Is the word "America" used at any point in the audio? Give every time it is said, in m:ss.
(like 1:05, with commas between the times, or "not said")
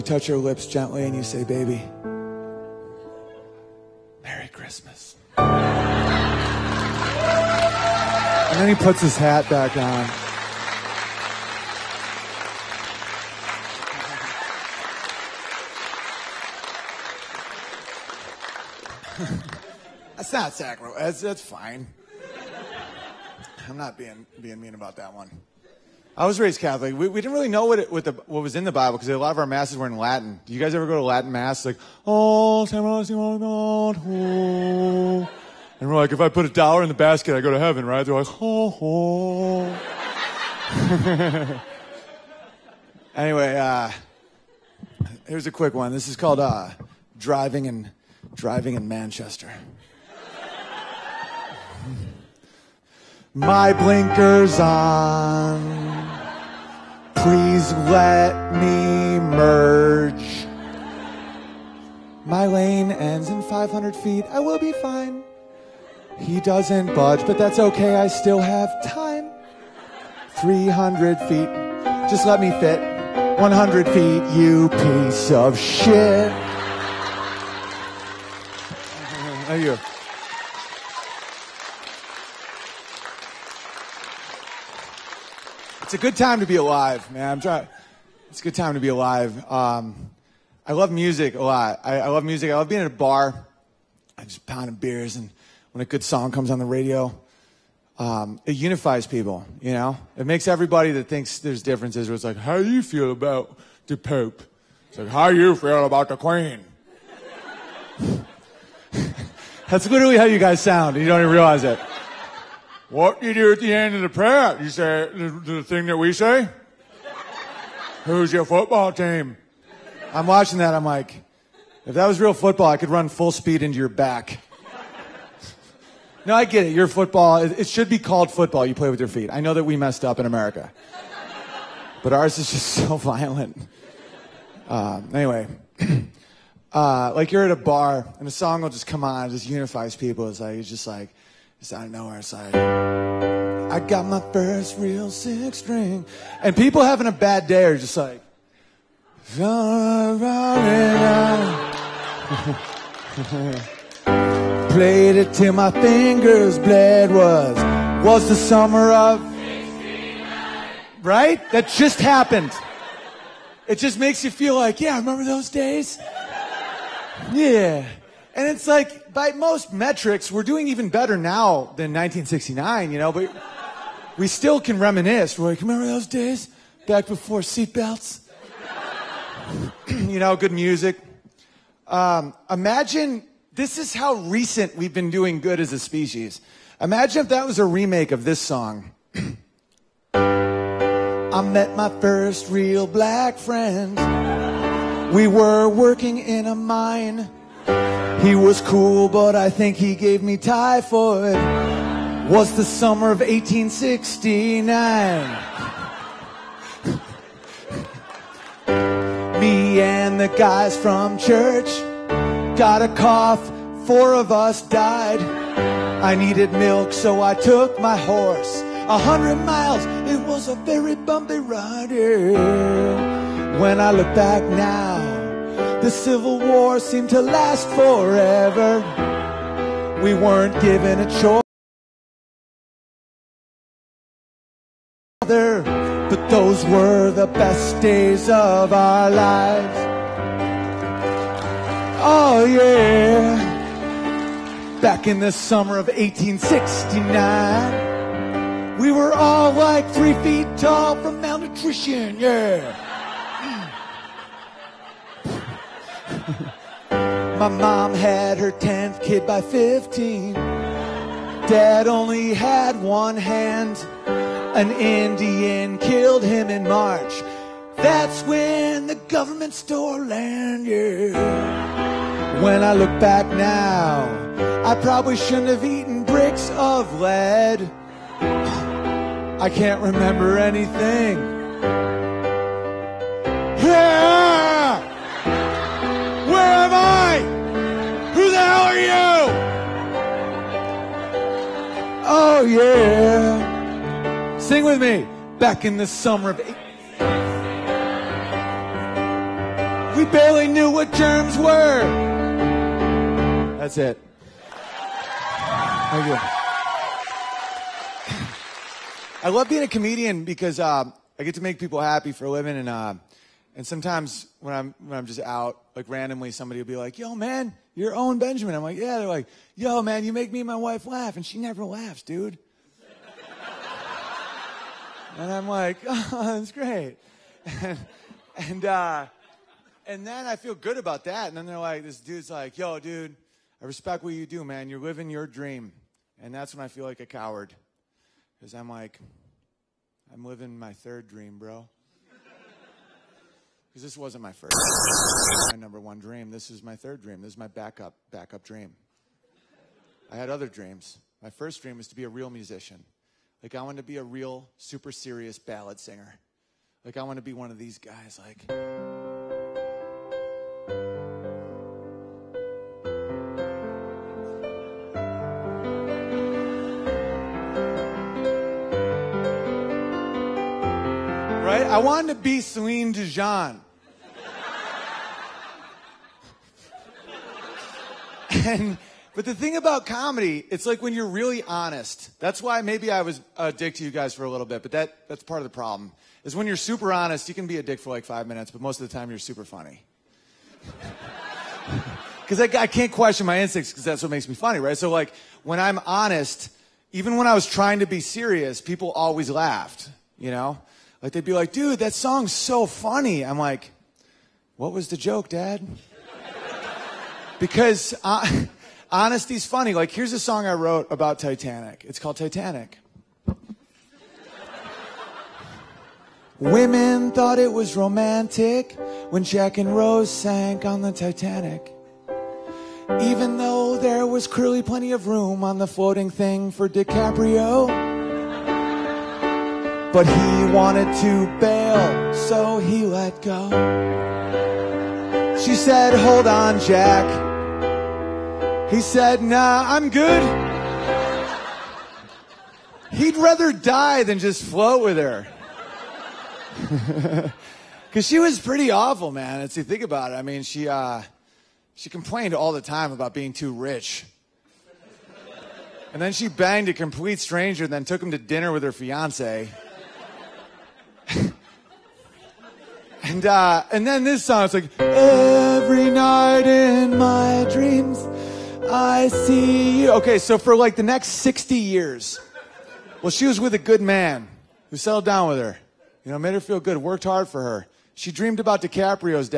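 2:10.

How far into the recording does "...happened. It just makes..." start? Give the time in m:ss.
2:41.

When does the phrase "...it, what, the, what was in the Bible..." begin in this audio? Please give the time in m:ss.
0:27.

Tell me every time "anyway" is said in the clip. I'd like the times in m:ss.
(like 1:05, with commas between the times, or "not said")
0:43, 2:15.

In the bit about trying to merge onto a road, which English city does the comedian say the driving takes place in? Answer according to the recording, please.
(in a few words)
Manchester.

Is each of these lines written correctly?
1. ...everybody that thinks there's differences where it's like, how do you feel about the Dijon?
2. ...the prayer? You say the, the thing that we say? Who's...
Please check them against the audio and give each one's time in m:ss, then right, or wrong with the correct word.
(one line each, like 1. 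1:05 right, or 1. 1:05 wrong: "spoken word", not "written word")
1. 1:40 wrong: "Pope", not "Dijon"
2. 1:54 right.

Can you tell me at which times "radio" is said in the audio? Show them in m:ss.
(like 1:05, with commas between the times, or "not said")
1:36.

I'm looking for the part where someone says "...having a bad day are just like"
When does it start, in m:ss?
2:26.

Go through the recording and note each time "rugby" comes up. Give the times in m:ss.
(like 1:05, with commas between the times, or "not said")
not said.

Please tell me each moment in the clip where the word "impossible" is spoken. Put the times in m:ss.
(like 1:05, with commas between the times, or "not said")
not said.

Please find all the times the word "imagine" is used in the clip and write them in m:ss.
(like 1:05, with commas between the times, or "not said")
3:02, 3:06.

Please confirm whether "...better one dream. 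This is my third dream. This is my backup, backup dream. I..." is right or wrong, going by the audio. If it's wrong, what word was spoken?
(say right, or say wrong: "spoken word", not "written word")
wrong: "number", not "better".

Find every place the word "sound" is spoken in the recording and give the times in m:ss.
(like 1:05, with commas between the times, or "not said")
1:50.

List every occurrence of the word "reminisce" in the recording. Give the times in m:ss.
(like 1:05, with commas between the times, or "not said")
2:54.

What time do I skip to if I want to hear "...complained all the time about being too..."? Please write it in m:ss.
7:31.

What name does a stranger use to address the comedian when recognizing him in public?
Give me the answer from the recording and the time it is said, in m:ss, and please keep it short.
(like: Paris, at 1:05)
Owen Benjamin, at 5:17.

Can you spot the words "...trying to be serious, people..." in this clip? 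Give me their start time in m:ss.
6:37.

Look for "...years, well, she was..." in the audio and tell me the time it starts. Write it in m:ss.
7:51.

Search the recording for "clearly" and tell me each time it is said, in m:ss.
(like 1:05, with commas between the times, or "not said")
7:04.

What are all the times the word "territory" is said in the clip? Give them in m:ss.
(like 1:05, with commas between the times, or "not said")
not said.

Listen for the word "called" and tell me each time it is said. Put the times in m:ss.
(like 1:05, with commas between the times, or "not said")
0:46, 2:07, 6:51.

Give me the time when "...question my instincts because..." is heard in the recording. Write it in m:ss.
6:32.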